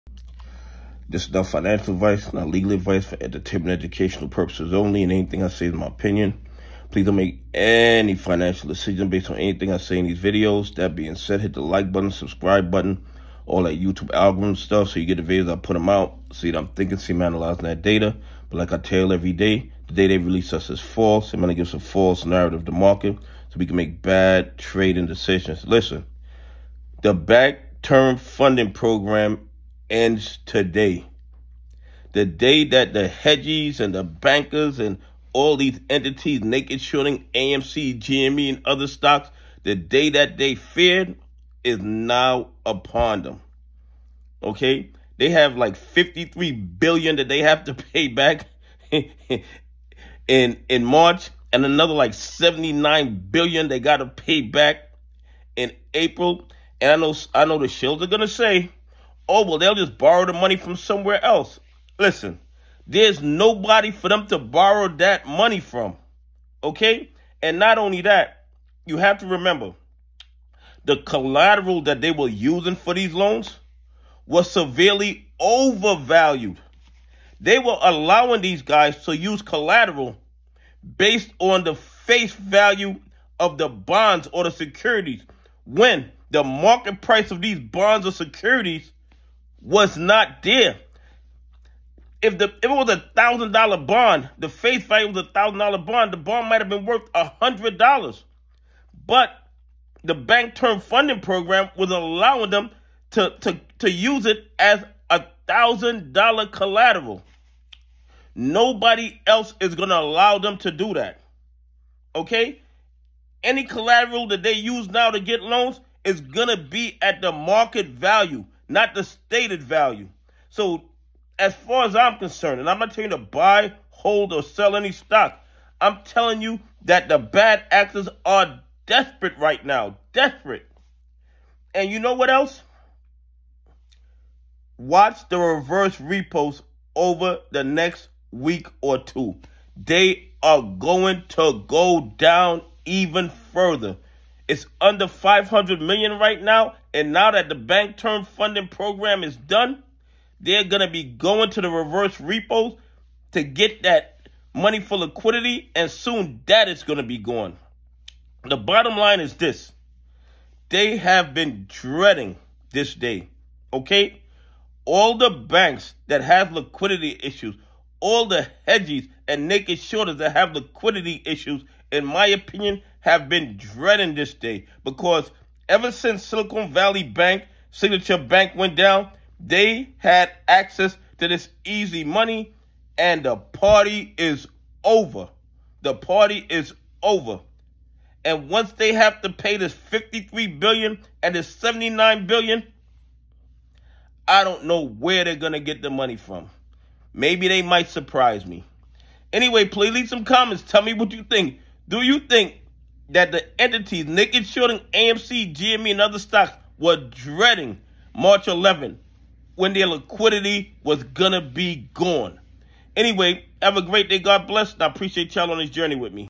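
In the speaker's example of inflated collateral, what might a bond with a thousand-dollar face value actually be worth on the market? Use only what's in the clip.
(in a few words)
$100.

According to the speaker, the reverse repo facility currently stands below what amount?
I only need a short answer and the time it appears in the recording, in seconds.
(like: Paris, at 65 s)
$500 million, at 145 s.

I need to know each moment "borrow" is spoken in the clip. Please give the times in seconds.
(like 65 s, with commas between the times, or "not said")
59 s, 64 s.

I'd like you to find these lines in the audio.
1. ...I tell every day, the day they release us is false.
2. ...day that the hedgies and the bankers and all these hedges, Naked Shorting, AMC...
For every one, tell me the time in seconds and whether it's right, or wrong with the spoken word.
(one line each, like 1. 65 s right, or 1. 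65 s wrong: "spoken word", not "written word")
1. 18 s right
2. 32 s wrong: "entities", not "hedges".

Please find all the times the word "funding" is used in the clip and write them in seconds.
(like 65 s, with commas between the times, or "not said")
28 s, 100 s, 148 s.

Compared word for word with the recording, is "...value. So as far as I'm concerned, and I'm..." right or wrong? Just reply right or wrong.
right.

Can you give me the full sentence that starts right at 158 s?
The bottom line is this they have been dreading this day.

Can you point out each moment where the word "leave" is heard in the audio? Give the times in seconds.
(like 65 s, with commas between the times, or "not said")
199 s.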